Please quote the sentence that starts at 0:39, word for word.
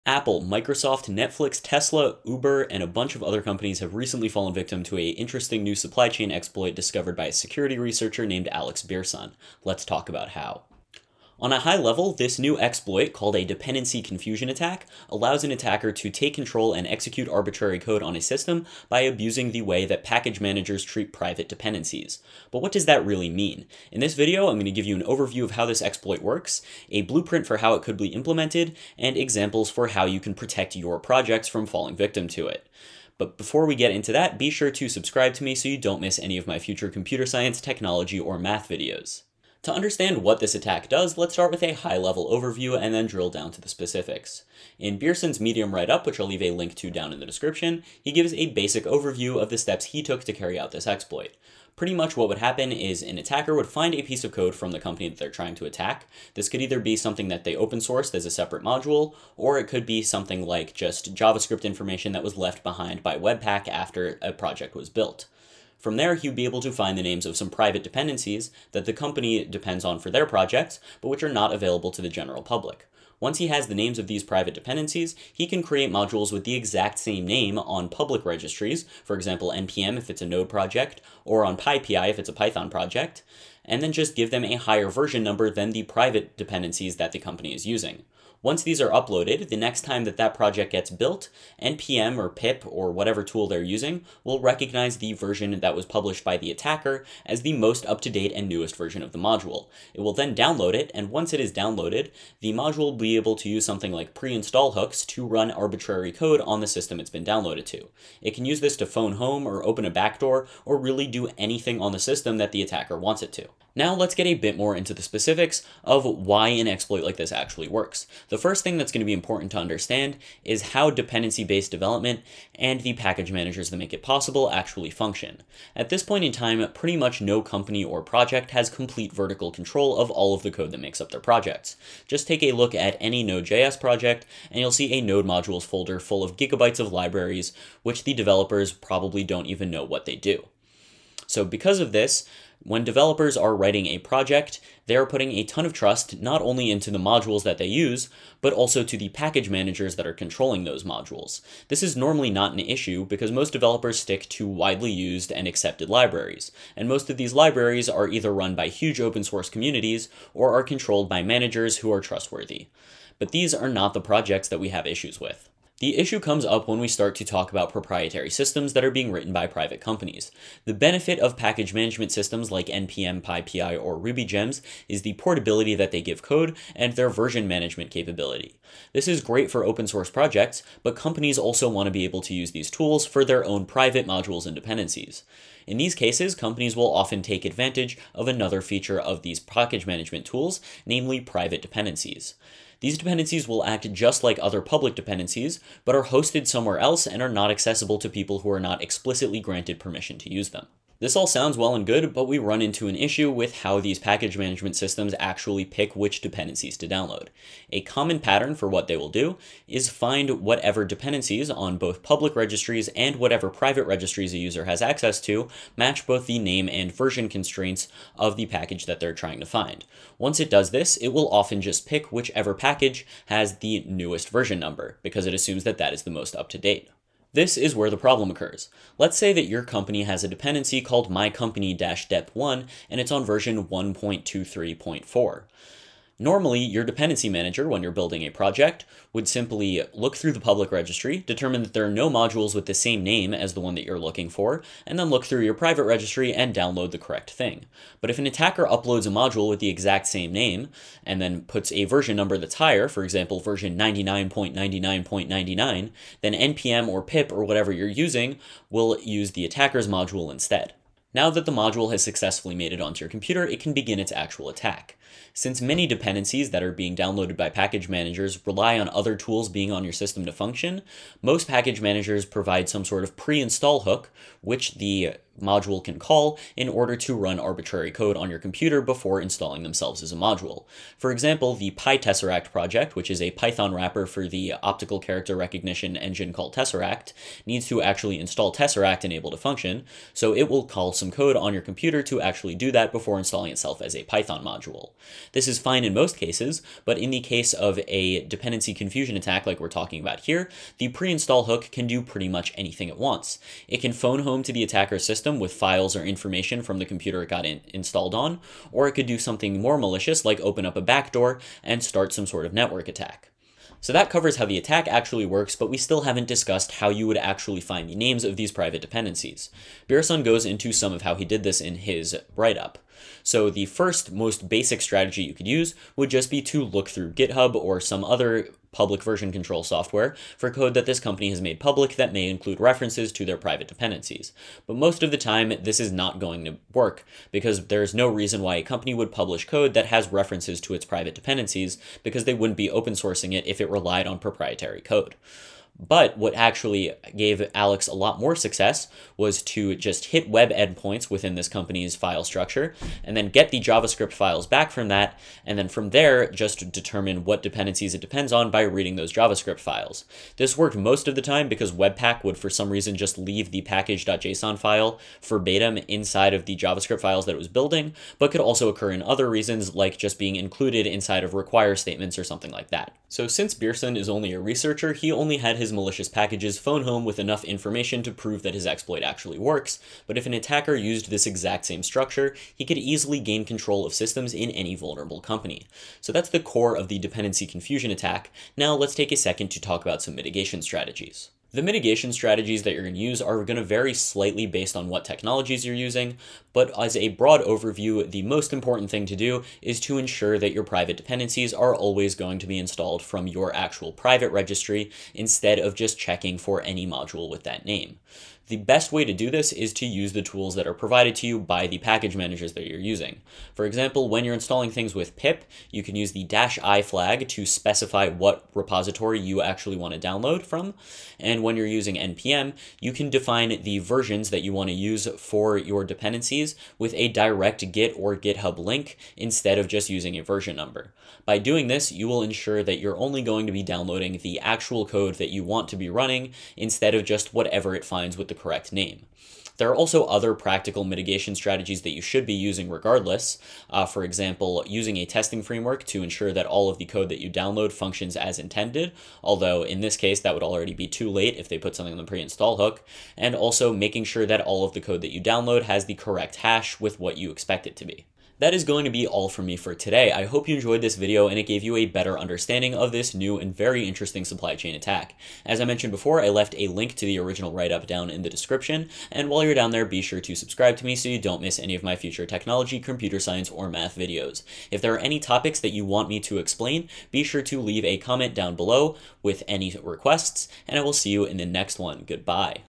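To understand what this attack does, let's start with a high-level overview and then drill down to the specifics.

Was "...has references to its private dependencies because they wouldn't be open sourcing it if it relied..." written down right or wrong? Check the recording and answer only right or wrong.
right.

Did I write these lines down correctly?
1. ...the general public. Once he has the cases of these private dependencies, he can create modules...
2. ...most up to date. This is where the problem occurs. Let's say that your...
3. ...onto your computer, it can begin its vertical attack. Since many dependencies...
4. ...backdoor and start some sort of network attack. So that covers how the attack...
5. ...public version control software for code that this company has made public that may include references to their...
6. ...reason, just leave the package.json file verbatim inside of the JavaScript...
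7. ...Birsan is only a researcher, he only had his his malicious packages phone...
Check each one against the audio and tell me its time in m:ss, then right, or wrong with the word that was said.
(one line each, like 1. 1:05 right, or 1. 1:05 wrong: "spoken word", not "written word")
1. 1:12 wrong: "names", not "cases"
2. 3:46 right
3. 4:22 wrong: "actual", not "vertical"
4. 5:10 right
5. 5:28 right
6. 6:02 right
7. 6:13 right.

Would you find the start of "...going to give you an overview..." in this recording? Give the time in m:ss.
0:24.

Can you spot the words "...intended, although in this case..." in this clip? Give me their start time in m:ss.
7:28.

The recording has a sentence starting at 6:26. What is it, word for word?
So that's the core of the dependency confusion attack.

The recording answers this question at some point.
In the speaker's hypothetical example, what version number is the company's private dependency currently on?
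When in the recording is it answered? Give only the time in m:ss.
3:53.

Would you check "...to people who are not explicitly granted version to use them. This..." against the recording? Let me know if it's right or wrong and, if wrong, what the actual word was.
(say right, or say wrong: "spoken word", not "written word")
wrong: "permission", not "version".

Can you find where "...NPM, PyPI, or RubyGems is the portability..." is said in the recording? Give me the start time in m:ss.
2:52.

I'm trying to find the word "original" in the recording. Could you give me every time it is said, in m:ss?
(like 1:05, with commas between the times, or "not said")
7:47.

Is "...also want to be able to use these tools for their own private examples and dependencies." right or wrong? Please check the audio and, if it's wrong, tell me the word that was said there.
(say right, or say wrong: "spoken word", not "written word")
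wrong: "modules", not "examples".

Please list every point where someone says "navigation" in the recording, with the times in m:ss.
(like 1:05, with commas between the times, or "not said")
not said.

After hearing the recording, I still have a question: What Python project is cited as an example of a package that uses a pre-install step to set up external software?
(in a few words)
PyTesseract.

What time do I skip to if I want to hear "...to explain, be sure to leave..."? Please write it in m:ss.
7:56.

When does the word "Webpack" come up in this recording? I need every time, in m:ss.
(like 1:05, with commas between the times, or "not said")
1:03, 6:01.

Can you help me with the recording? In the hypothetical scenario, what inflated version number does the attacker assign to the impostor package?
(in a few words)
99.99.99.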